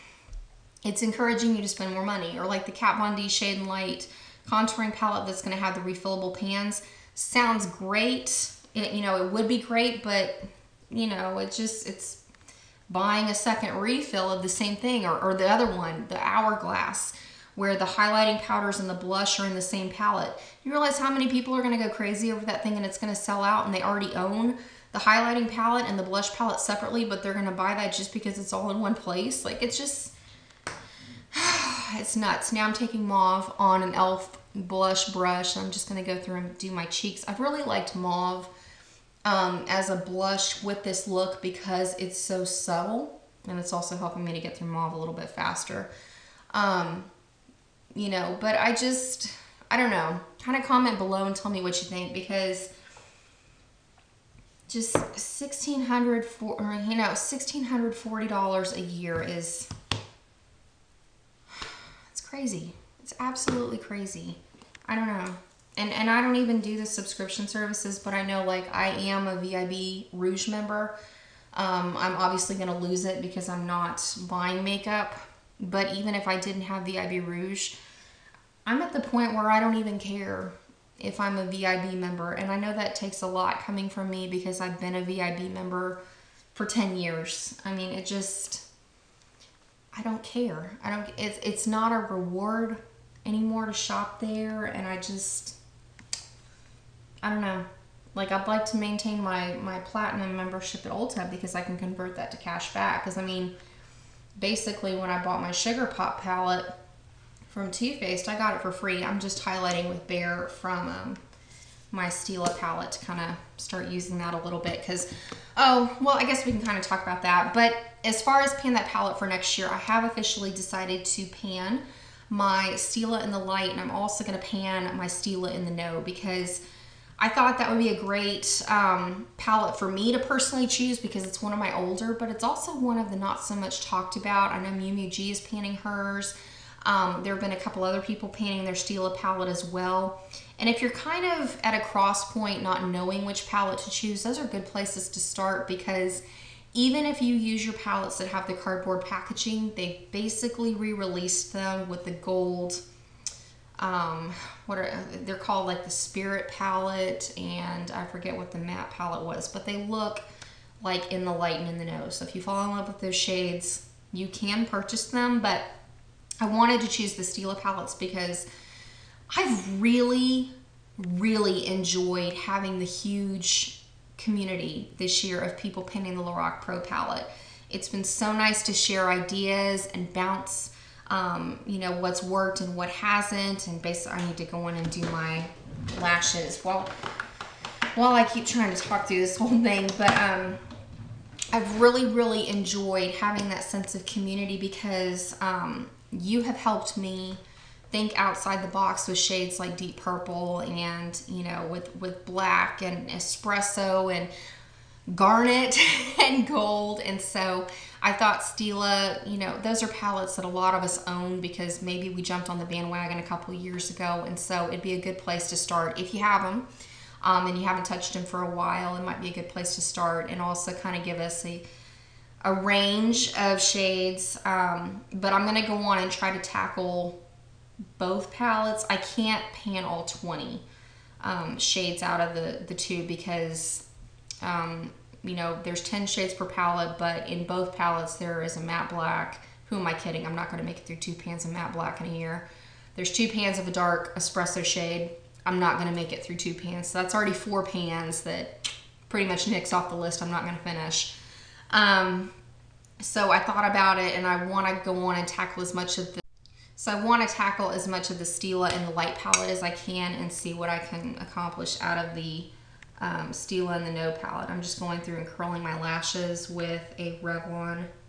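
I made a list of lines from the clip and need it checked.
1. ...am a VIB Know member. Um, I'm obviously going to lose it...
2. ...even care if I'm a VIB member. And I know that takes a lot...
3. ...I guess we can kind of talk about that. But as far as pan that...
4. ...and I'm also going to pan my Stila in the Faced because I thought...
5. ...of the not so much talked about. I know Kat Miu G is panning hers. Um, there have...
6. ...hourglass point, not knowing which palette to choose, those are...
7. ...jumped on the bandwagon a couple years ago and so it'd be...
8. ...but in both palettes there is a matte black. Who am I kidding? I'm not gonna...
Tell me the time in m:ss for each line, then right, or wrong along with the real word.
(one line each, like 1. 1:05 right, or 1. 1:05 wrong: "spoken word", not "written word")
1. 1:08 wrong: "Rouge", not "Know"
2. 1:19 right
3. 1:56 right
4. 2:03 wrong: "Know", not "Faced"
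5. 2:12 wrong: "Miu", not "Kat"
6. 2:21 wrong: "cross", not "hourglass"
7. 3:32 right
8. 3:56 right.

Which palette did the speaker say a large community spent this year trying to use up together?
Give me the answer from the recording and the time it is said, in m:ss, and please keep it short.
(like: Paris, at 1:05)
Lorac Pro palette, at 2:55.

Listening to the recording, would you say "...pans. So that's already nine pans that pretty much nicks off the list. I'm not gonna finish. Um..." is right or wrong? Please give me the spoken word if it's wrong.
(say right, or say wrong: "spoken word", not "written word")
wrong: "four", not "nine".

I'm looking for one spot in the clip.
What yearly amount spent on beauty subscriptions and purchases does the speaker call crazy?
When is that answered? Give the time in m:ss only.
0:57.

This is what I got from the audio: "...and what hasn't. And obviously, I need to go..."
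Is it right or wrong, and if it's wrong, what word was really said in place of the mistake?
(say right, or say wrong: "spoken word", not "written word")
wrong: "basically", not "obviously".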